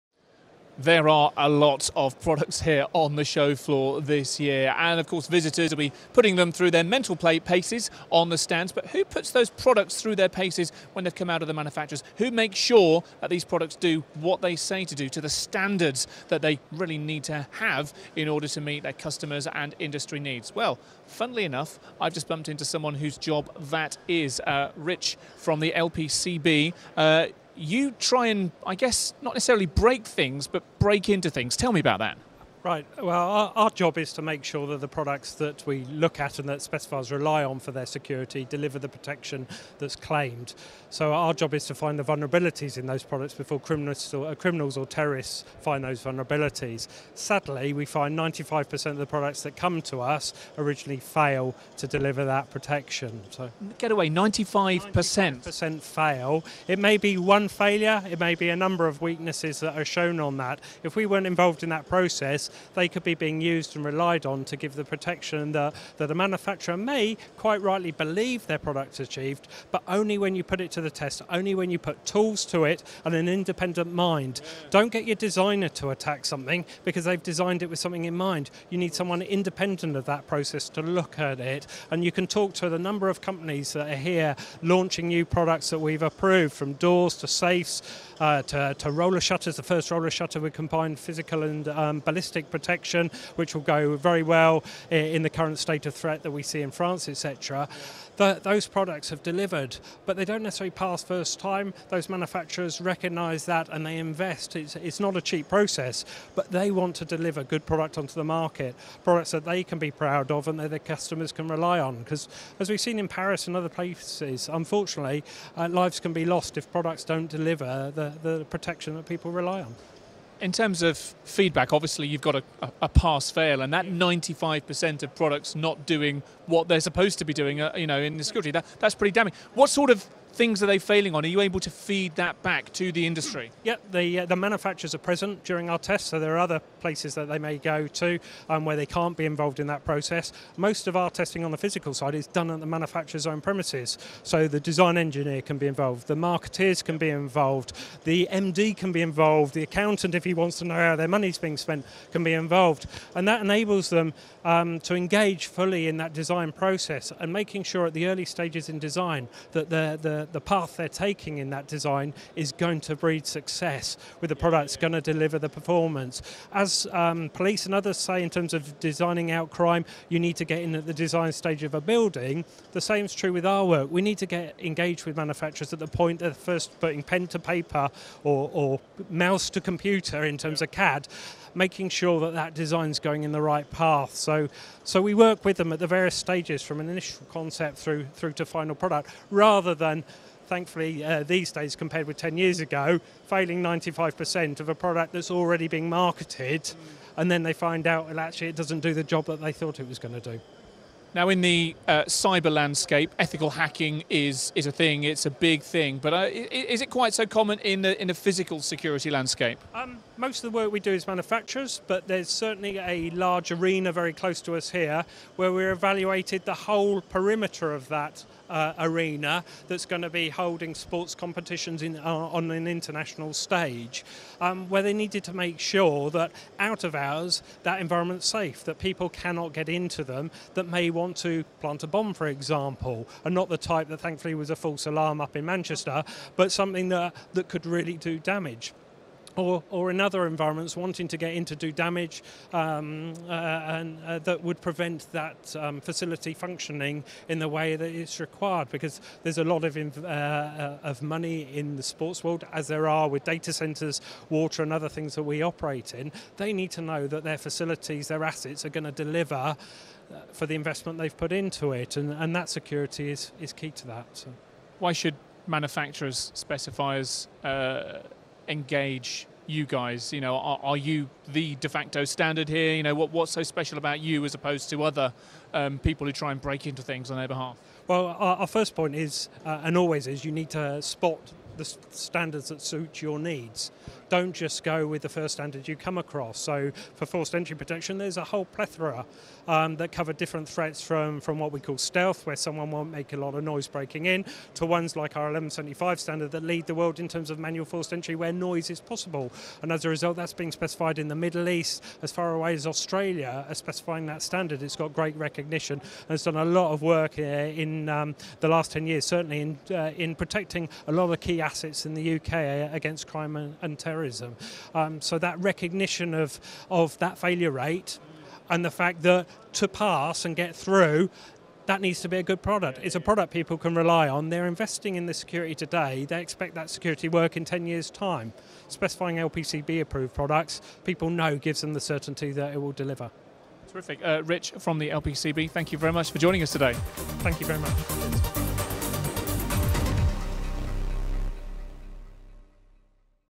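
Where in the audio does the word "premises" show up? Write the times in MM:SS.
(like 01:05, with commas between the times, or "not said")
02:23.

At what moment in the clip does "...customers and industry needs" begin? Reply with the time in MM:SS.
00:18.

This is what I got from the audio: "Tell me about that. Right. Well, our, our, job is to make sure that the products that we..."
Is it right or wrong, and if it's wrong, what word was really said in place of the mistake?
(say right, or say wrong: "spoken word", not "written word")
right.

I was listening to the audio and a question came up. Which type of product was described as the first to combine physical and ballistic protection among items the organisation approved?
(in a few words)
roller shutter.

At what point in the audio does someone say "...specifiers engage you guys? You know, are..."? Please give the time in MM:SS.
04:26.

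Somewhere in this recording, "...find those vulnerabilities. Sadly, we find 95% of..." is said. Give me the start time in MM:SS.
00:45.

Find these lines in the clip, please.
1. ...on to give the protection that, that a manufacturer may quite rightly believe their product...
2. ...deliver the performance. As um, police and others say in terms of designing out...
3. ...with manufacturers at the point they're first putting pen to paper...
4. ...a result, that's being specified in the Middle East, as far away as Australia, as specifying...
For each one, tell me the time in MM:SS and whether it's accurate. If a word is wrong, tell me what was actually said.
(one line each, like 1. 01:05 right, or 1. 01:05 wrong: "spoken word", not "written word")
1. 01:04 right
2. 02:45 right
3. 02:55 right
4. 04:59 right.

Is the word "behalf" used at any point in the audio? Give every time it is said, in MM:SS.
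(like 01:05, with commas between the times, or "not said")
04:37.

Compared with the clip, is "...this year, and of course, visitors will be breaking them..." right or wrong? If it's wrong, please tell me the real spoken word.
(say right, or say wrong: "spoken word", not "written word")
wrong: "putting", not "breaking".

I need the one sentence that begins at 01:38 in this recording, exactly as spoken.
Those products have delivered, but they don't necessarily pass first time.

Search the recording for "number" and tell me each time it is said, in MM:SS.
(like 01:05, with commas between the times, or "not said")
00:58, 01:22.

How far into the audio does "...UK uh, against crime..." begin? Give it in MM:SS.
05:12.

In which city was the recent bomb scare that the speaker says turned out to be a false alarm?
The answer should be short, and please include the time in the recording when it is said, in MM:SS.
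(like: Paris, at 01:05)
Manchester, at 03:55.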